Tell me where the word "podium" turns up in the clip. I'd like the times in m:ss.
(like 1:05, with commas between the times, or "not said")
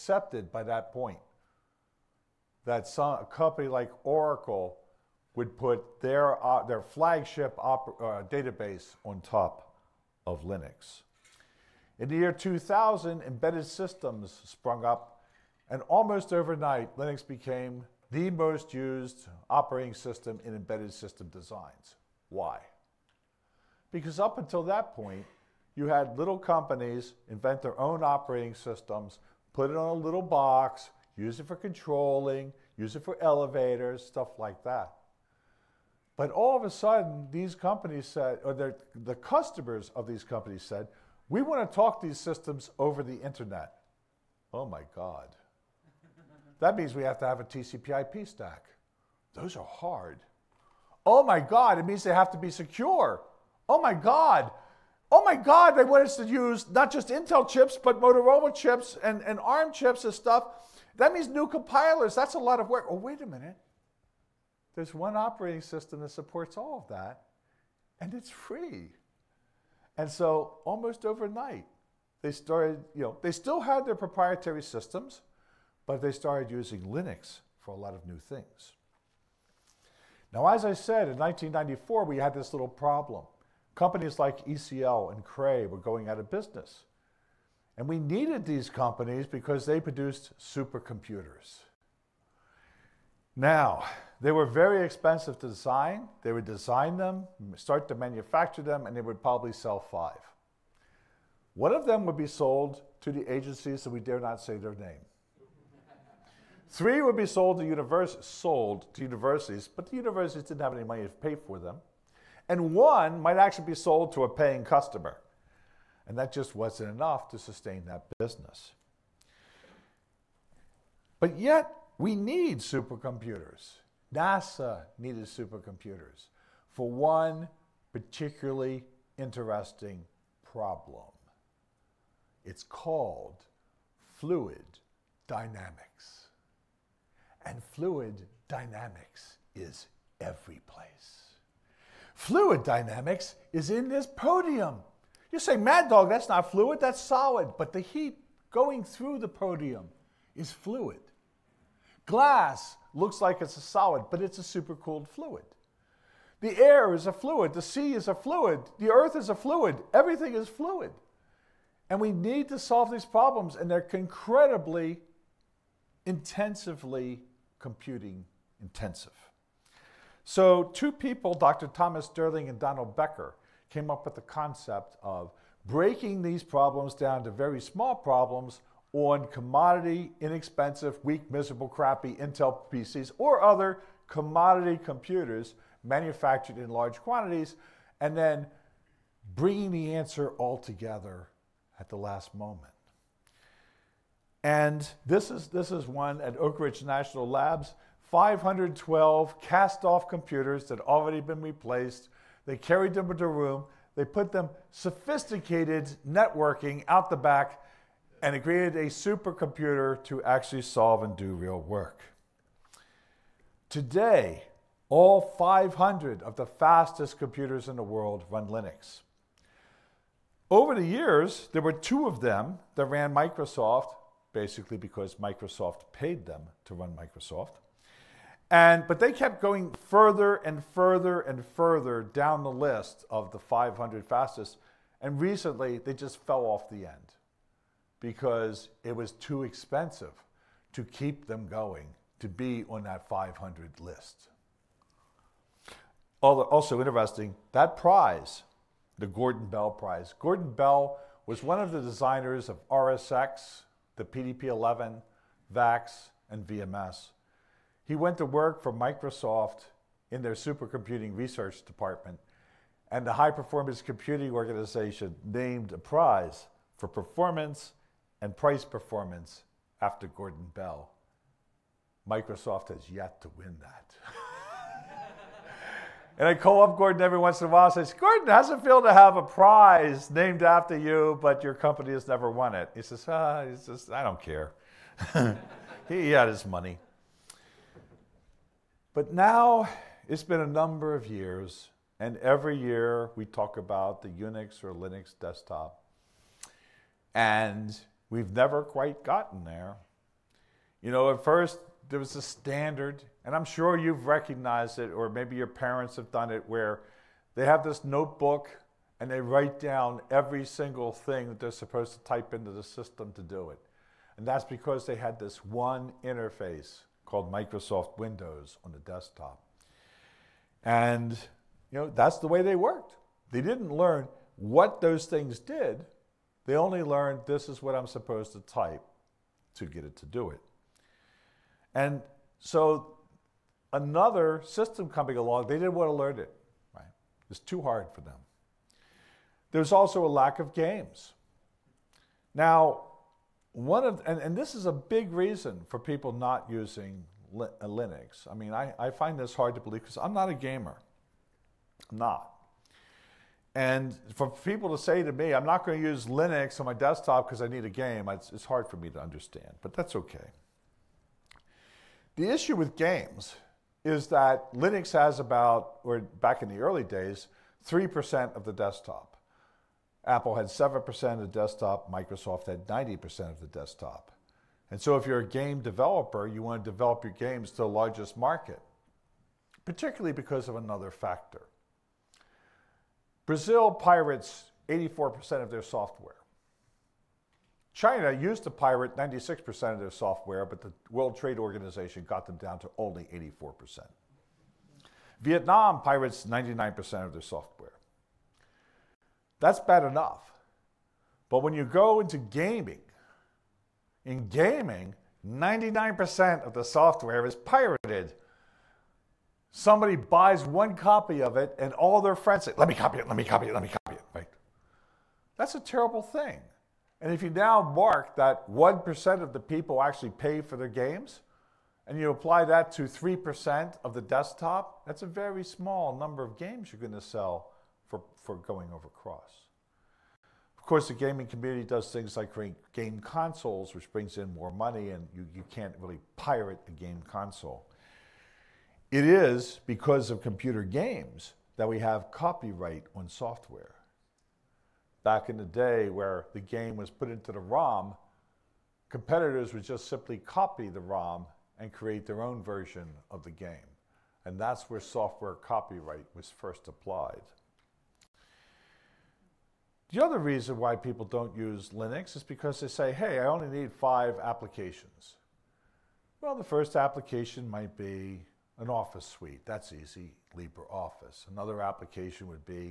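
2:24, 2:29.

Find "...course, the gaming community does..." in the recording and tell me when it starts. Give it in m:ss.
7:10.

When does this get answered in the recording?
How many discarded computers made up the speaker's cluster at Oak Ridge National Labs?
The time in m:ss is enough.
3:18.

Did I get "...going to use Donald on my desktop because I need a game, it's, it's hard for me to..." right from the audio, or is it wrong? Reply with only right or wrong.
wrong.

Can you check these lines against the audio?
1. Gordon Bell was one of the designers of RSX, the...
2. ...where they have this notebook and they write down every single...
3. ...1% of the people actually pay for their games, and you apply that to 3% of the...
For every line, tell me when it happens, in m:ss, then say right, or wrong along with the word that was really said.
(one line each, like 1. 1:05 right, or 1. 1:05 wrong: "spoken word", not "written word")
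1. 4:10 right
2. 5:06 right
3. 6:58 right.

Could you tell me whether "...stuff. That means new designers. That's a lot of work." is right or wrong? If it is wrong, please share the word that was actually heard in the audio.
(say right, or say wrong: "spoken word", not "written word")
wrong: "compilers", not "designers".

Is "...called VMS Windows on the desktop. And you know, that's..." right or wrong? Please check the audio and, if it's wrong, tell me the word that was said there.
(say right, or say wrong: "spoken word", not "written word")
wrong: "Microsoft", not "VMS".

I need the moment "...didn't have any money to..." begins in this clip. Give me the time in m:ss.
1:50.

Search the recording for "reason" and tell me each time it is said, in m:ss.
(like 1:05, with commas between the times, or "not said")
5:45, 7:40.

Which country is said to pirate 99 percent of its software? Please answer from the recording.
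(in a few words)
Vietnam.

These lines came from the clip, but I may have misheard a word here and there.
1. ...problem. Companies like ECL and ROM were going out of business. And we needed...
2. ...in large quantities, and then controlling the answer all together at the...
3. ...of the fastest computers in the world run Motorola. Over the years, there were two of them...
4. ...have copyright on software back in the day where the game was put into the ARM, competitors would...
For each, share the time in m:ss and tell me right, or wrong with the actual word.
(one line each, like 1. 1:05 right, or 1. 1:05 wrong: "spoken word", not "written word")
1. 1:22 wrong: "Cray", not "ROM"
2. 3:06 wrong: "bringing", not "controlling"
3. 3:36 wrong: "Linux", not "Motorola"
4. 7:21 wrong: "ROM", not "ARM".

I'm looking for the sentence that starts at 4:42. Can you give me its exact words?
He says, ah, he says I don't care.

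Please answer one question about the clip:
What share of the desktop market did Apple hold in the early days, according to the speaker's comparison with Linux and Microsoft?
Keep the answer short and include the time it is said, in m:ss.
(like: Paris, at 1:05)
7%, at 6:10.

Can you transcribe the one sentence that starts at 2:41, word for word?
And we need to solve these problems, and they're incredibly, intensively computing intensive.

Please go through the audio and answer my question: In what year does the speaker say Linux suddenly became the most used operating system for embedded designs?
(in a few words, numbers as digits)
2000.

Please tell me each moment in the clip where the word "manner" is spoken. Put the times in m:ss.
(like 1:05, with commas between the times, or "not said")
not said.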